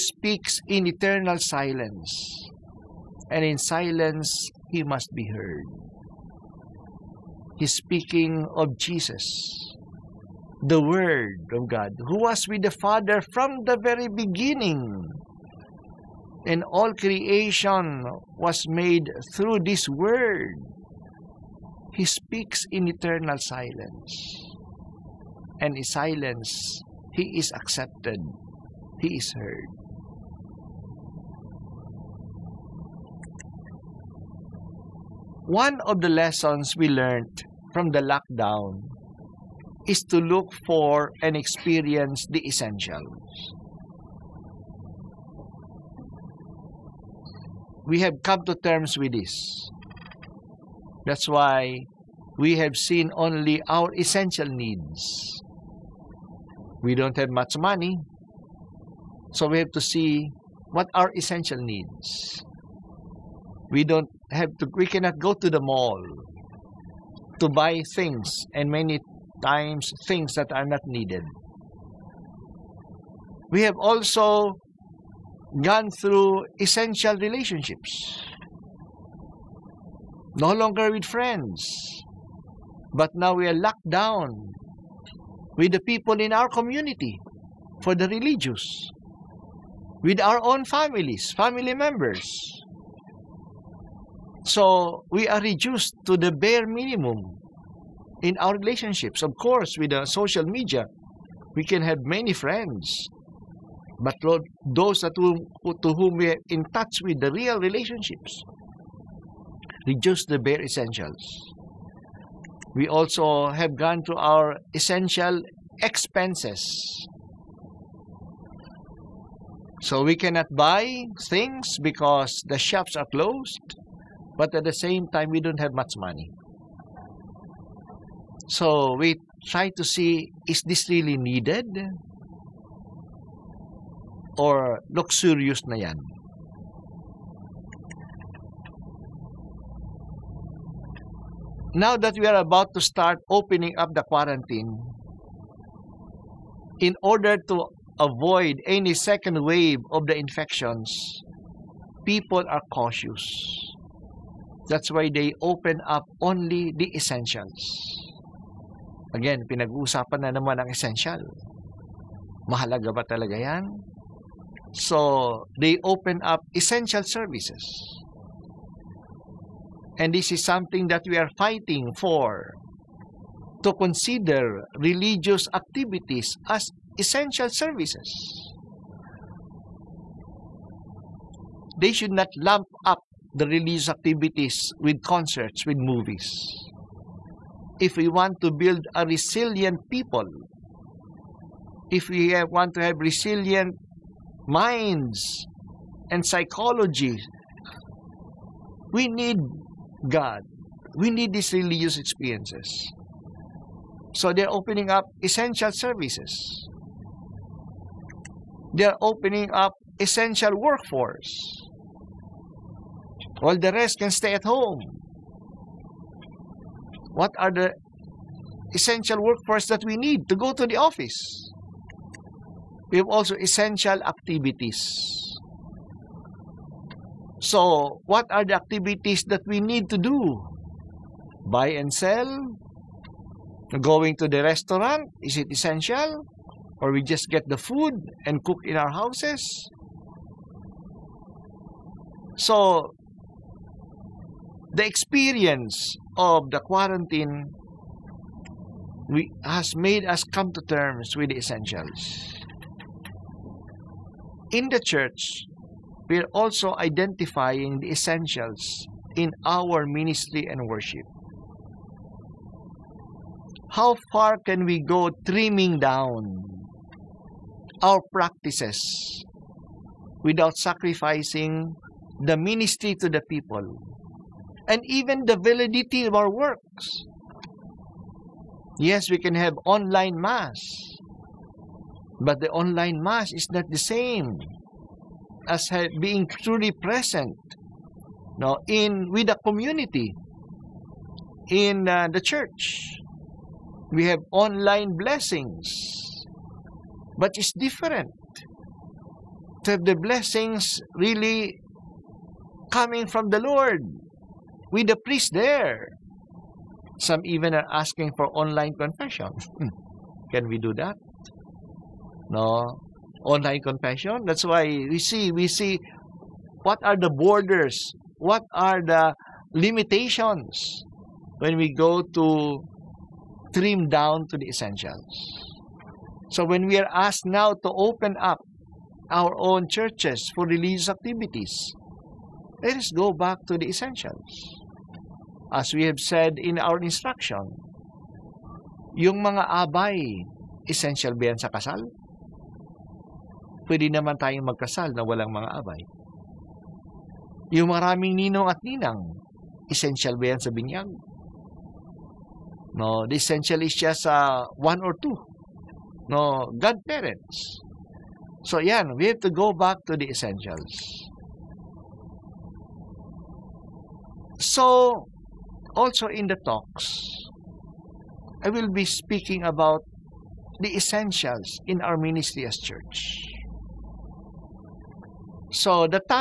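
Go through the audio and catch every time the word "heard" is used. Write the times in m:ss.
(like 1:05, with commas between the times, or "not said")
0:05, 0:29.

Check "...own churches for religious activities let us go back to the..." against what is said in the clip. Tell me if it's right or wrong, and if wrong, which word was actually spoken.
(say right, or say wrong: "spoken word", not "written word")
right.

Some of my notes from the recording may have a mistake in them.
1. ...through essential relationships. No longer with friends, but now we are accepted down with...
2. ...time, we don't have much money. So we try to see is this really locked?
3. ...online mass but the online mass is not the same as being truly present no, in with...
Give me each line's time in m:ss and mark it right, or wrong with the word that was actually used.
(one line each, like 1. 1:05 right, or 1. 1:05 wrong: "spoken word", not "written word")
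1. 1:16 wrong: "locked", not "accepted"
2. 2:05 wrong: "needed", not "locked"
3. 4:39 right.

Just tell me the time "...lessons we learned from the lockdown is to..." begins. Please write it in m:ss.
0:36.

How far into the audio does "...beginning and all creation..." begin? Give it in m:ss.
0:14.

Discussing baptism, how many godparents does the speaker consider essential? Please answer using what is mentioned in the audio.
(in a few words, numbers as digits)
1 or 2.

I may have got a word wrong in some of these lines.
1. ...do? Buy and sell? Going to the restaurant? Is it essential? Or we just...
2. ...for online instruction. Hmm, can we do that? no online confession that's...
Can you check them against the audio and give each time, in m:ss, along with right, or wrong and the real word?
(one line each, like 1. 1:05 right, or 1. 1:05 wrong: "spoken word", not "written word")
1. 3:49 right
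2. 5:08 wrong: "confession", not "instruction".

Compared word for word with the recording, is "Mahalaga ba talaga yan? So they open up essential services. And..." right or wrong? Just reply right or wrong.
right.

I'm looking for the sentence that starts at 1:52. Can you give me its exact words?
We also have gone to our essential expenses.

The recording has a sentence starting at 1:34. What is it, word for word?
So we are reduced to the bare minimum in our relationships.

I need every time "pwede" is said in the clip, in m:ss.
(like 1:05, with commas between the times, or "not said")
5:43.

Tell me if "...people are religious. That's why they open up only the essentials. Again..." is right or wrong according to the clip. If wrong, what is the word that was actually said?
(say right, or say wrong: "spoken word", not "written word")
wrong: "cautious", not "religious".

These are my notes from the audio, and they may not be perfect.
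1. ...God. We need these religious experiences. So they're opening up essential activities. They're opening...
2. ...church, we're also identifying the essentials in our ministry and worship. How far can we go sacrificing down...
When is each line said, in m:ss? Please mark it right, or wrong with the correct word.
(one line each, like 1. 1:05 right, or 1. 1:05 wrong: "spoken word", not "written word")
1. 3:20 wrong: "services", not "activities"
2. 4:14 wrong: "trimming", not "sacrificing".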